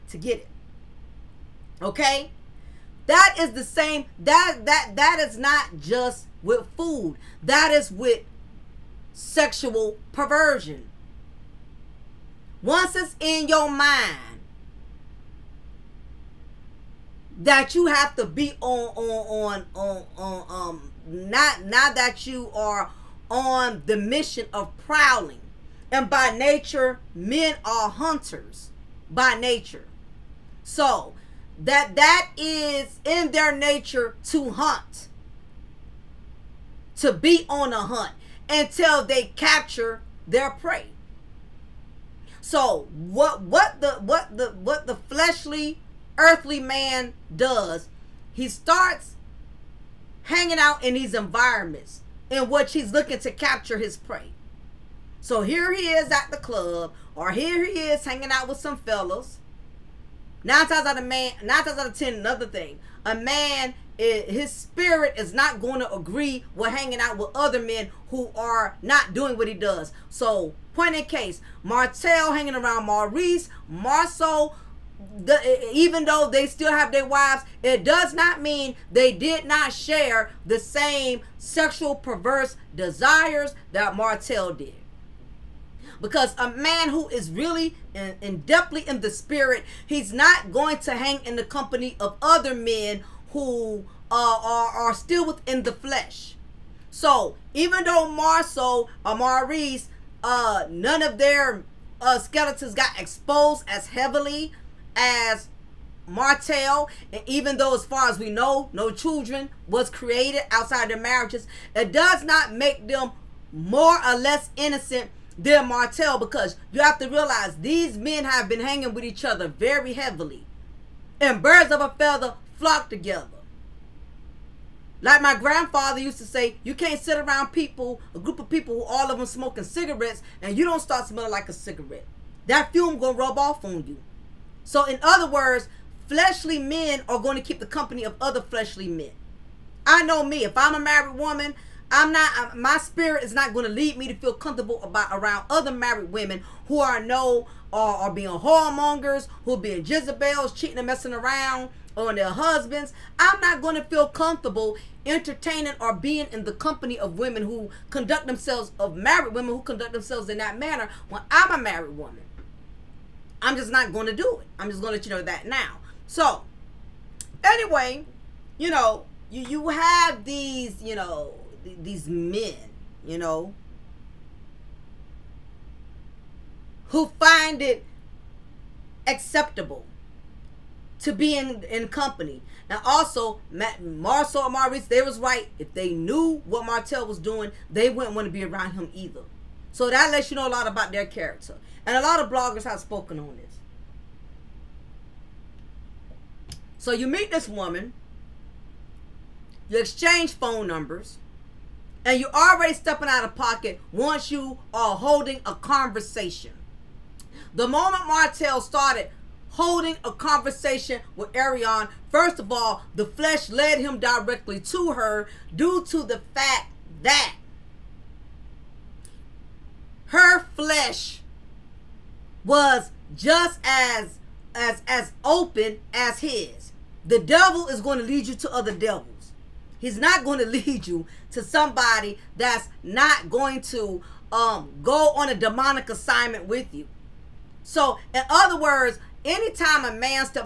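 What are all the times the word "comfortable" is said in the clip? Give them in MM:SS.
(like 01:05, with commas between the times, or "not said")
02:24, 02:34.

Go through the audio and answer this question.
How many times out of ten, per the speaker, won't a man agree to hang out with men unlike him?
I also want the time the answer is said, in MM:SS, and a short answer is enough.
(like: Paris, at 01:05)
10, at 01:01.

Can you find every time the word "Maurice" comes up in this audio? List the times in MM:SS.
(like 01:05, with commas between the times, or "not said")
01:12, 01:39, 03:04.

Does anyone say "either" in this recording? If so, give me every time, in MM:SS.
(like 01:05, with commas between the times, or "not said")
03:08.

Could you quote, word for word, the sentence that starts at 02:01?
And birds of a feather flock together.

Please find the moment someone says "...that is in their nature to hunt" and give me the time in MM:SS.
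00:31.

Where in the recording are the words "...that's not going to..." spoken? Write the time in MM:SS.
03:52.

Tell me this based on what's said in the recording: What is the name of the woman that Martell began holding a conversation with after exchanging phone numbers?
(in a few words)
Arionne.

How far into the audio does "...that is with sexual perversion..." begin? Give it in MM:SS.
00:07.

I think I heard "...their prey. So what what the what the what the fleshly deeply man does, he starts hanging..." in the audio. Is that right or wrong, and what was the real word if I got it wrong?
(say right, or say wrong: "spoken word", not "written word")
wrong: "earthly", not "deeply".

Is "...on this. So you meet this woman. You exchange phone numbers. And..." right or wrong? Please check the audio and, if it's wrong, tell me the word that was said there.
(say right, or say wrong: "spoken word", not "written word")
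right.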